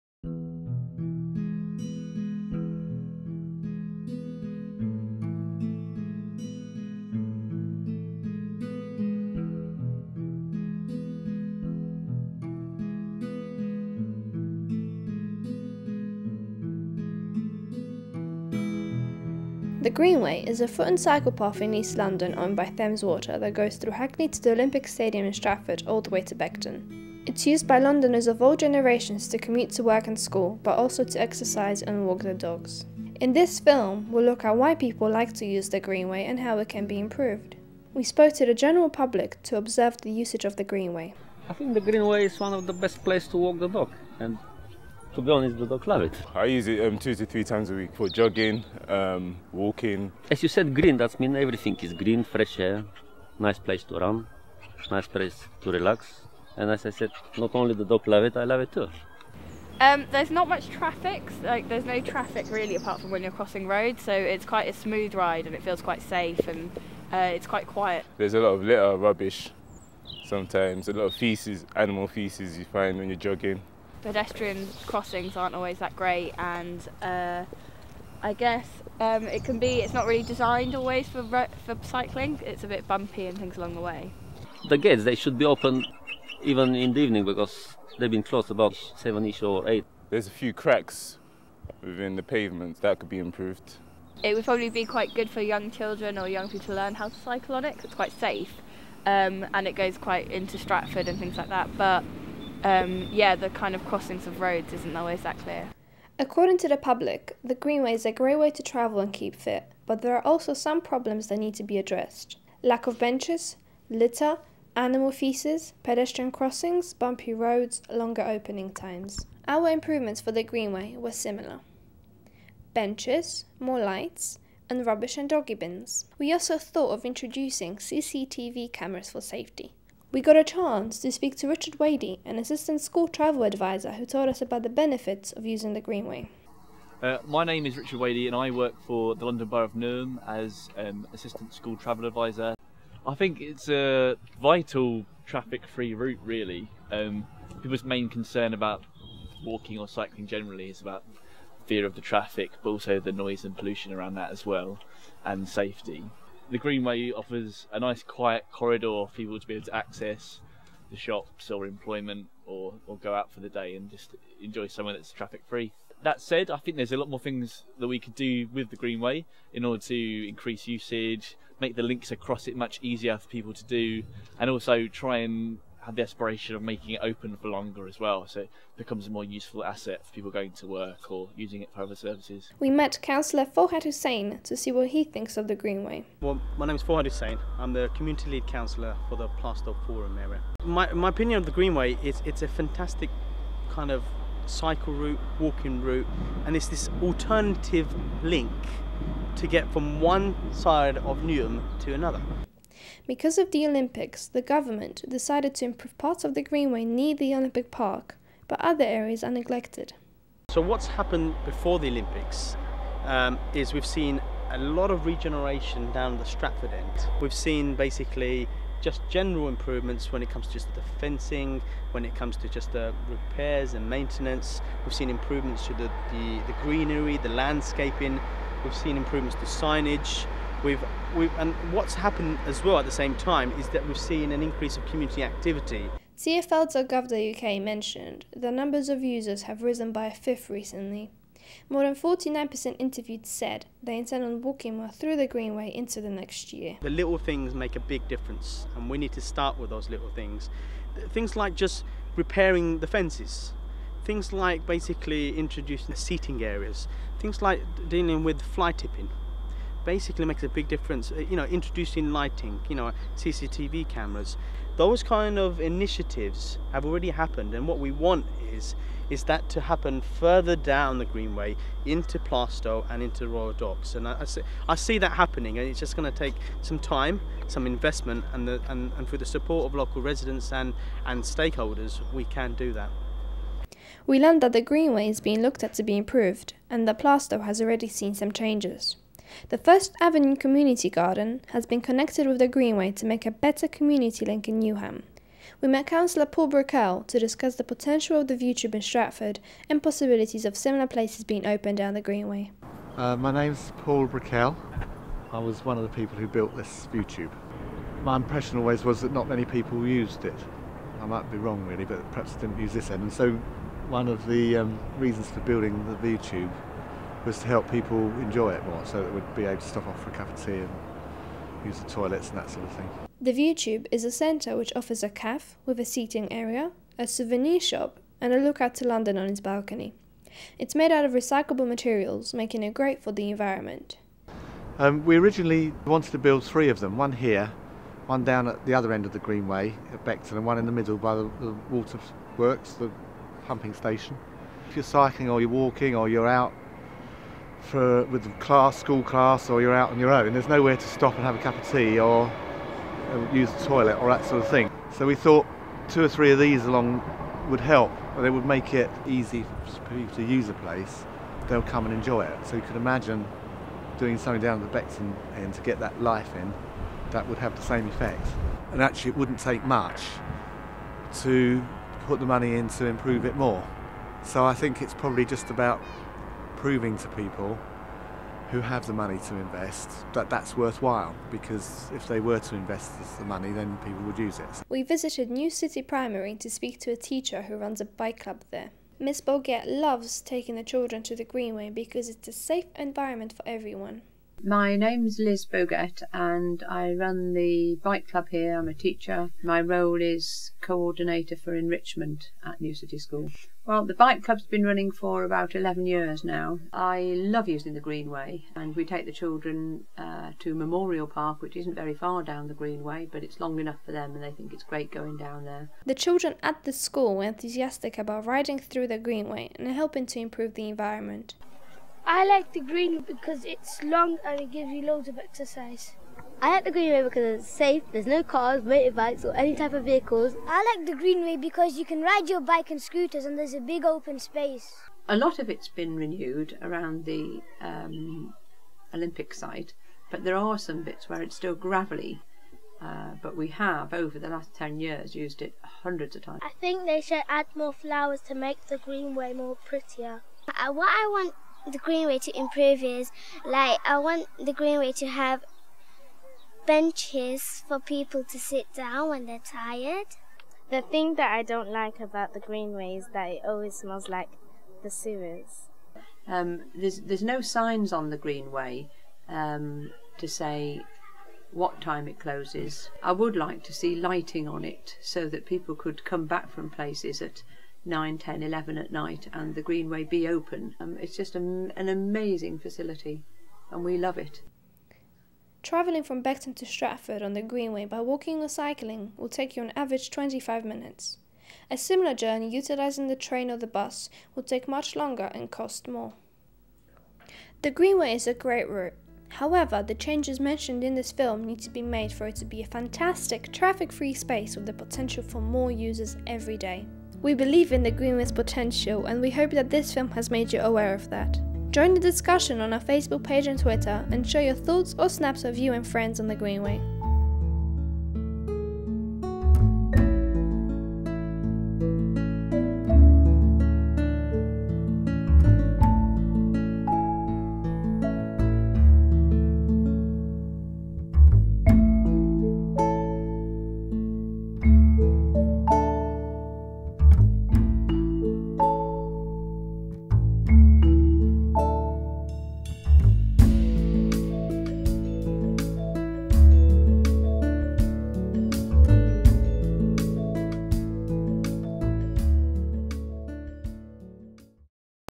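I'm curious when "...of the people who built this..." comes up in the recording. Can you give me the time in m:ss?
5:05.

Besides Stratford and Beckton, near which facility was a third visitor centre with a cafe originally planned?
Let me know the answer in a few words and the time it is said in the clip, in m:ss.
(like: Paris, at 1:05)
the pumping station, at 5:42.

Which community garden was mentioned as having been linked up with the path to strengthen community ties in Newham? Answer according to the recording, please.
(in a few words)
First Avenue Community Garden.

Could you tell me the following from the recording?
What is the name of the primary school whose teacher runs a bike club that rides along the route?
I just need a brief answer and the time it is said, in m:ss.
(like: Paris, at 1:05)
New City Primary, at 6:25.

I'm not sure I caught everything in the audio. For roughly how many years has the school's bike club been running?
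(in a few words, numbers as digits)
11.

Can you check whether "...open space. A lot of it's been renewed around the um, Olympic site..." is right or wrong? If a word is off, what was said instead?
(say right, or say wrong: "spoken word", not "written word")
right.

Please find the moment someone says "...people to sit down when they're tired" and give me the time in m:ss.
7:37.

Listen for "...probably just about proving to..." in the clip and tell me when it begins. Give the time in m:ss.
6:14.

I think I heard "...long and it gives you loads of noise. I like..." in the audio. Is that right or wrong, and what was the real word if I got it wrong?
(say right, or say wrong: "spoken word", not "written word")
wrong: "exercise", not "noise".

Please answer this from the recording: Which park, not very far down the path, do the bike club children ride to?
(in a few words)
Memorial Park.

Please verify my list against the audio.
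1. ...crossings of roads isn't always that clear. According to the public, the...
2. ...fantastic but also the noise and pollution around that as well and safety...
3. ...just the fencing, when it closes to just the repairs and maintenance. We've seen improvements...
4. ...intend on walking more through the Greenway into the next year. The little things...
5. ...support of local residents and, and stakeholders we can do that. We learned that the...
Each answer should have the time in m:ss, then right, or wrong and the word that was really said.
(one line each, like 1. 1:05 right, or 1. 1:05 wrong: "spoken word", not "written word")
1. 1:43 right
2. 2:32 wrong: "traffic", not "fantastic"
3. 3:40 wrong: "comes", not "closes"
4. 4:03 right
5. 4:39 right.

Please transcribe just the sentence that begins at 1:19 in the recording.
It's not really designed always for for cycling.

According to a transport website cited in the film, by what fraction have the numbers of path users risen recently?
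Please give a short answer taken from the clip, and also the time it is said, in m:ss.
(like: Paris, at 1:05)
a fifth, at 4:00.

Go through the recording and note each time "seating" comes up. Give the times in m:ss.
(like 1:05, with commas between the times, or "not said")
4:15, 5:25.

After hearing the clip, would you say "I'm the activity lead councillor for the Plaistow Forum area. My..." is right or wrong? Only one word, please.
wrong.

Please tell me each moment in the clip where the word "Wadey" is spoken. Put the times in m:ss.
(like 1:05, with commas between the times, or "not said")
2:11, 2:17.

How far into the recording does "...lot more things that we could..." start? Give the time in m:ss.
2:46.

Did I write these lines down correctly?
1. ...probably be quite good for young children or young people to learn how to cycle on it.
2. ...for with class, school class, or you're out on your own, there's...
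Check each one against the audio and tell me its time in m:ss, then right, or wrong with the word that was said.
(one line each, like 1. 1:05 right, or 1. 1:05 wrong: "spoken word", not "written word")
1. 1:34 right
2. 5:47 right.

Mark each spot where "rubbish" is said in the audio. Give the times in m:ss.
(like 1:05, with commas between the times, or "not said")
1:08, 2:04.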